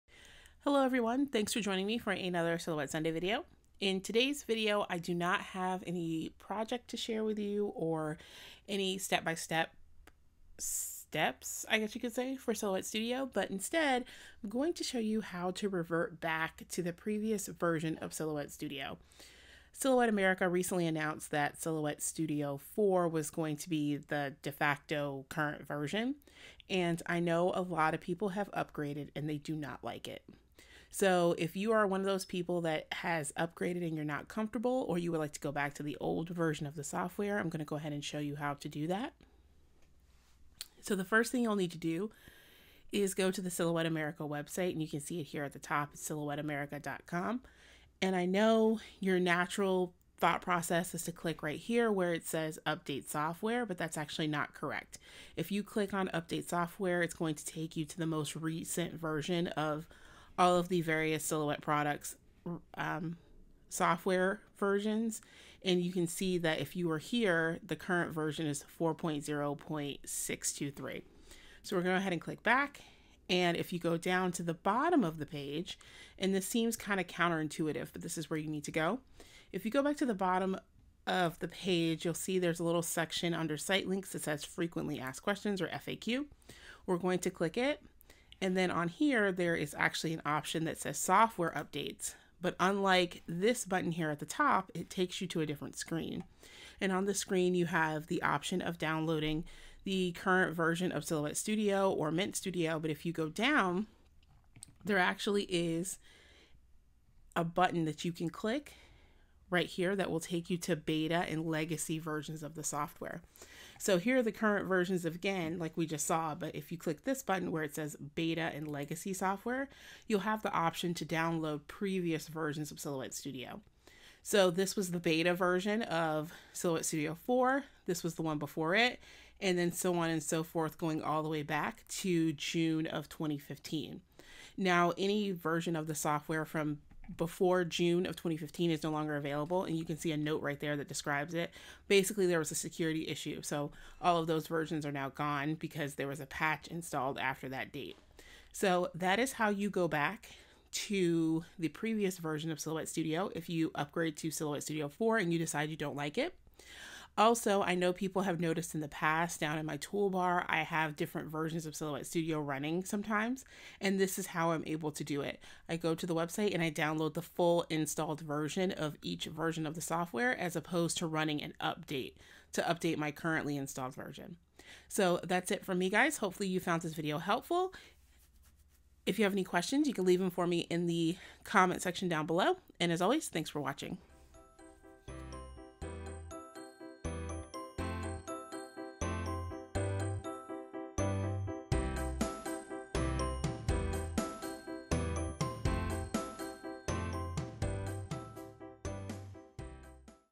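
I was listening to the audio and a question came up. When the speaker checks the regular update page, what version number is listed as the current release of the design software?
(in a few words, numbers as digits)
4.0.623.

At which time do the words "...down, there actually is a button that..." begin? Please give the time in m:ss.
1:43.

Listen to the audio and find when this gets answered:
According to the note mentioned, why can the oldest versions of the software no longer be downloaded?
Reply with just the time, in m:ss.
2:22.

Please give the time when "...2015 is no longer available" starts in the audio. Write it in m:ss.
2:18.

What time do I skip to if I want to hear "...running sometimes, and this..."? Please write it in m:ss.
2:42.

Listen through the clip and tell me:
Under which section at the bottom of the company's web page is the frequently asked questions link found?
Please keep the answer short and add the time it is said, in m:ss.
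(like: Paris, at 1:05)
site links, at 1:23.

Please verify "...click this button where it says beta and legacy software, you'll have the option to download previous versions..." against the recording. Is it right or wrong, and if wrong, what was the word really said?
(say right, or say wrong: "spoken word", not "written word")
right.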